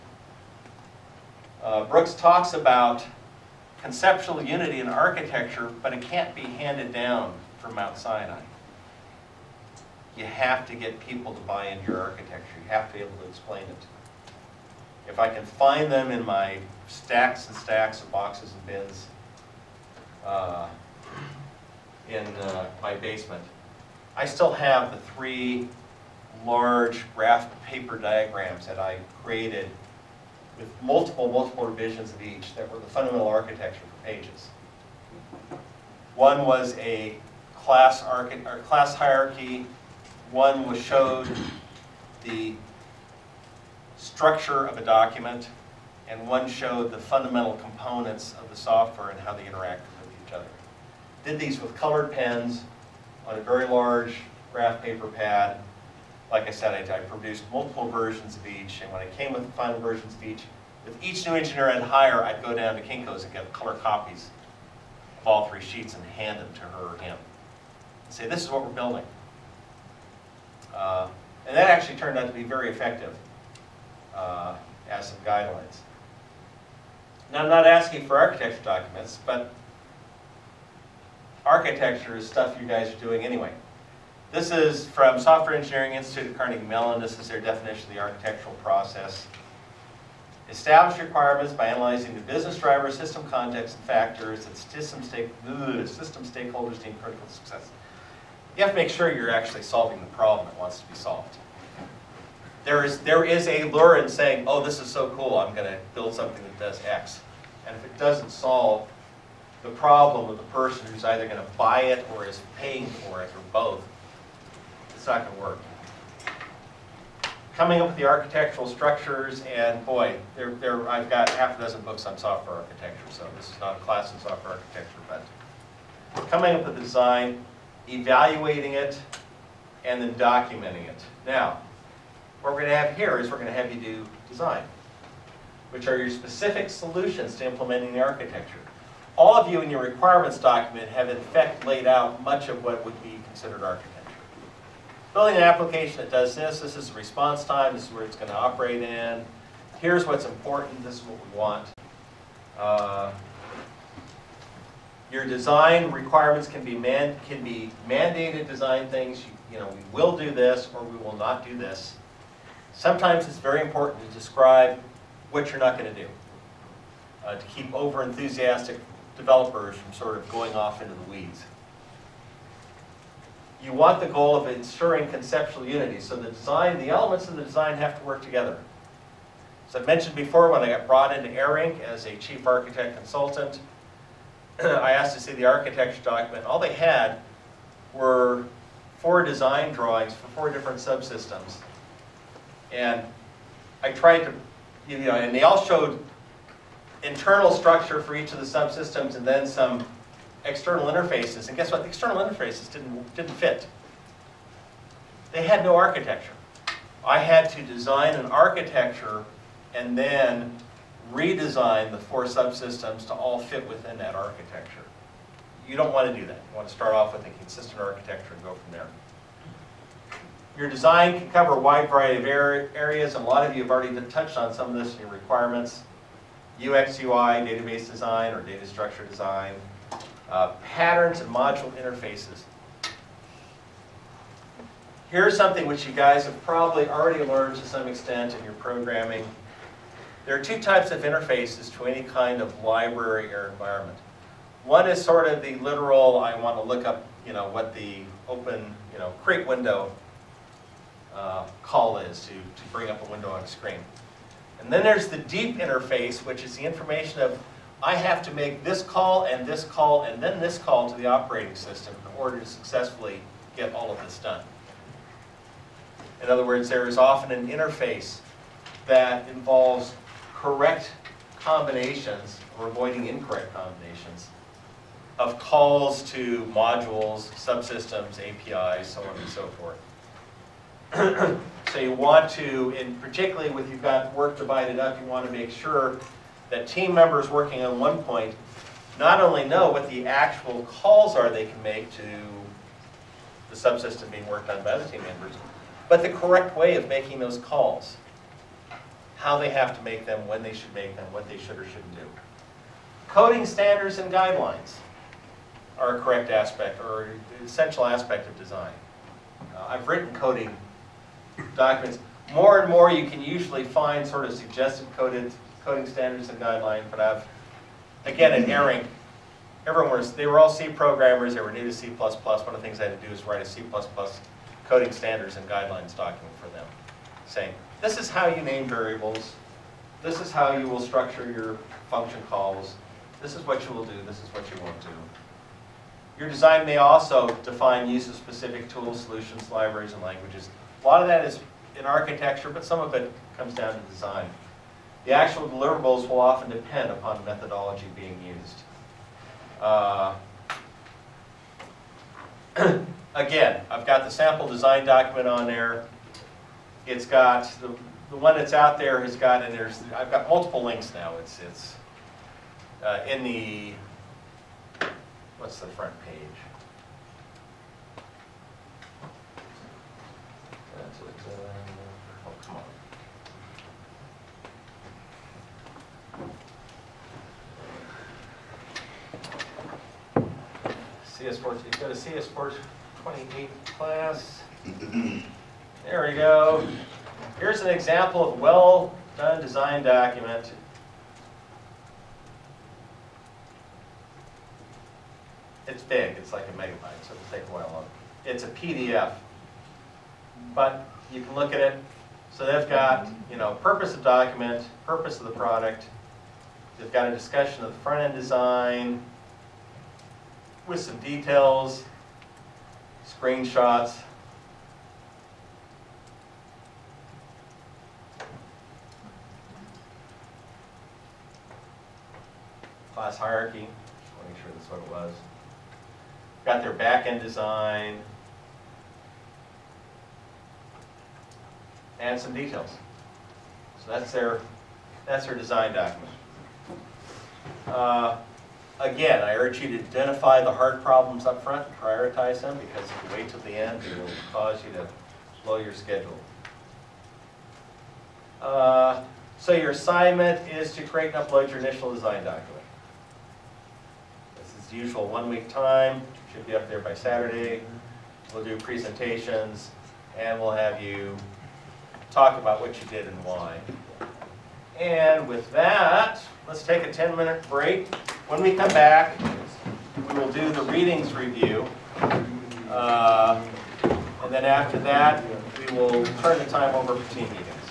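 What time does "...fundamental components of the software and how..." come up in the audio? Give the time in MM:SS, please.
00:46.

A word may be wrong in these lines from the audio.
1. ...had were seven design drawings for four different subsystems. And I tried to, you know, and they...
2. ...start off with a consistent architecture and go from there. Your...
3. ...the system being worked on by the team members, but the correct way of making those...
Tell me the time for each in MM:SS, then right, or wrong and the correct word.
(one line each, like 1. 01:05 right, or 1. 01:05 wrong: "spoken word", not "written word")
1. 03:06 wrong: "four", not "seven"
2. 03:36 right
3. 04:53 wrong: "subsystem", not "system".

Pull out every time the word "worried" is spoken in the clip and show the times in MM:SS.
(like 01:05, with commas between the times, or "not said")
not said.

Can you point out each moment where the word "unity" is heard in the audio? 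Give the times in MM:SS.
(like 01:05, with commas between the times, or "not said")
00:04, 02:55.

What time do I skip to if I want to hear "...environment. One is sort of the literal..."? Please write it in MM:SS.
04:03.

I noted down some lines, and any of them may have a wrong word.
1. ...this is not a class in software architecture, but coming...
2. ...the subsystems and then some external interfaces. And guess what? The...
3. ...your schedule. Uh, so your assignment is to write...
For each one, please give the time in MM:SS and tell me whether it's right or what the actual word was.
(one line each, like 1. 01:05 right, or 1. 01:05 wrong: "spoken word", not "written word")
1. 02:03 right
2. 03:18 right
3. 07:25 wrong: "create", not "write".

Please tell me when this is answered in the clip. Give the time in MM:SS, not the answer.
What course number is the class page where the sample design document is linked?
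06:21.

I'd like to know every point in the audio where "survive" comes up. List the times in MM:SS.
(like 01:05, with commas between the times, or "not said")
not said.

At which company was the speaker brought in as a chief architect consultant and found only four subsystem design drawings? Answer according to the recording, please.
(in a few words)
AirInc.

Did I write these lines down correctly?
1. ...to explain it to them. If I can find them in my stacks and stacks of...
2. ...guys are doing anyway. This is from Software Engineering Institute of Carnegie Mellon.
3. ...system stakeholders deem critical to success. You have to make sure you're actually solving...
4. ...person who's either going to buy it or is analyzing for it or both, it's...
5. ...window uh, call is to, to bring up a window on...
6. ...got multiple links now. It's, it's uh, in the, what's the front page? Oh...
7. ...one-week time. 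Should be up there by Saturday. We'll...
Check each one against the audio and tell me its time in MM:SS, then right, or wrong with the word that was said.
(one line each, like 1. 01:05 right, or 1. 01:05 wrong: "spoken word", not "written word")
1. 00:13 right
2. 01:22 right
3. 01:35 right
4. 01:50 wrong: "paying", not "analyzing"
5. 04:09 right
6. 06:00 right
7. 07:35 right.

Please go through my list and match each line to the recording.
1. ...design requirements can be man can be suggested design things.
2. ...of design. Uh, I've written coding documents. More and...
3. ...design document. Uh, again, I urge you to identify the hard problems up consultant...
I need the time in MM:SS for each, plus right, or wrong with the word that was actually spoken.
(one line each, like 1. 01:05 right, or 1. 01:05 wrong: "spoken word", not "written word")
1. 02:35 wrong: "mandated", not "suggested"
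2. 05:08 right
3. 07:15 wrong: "front", not "consultant".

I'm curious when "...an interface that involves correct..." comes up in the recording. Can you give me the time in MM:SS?
04:27.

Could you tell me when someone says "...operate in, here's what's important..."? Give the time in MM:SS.
02:28.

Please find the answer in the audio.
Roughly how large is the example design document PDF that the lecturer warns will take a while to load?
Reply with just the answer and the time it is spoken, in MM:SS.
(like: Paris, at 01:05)
a megabyte, at 06:36.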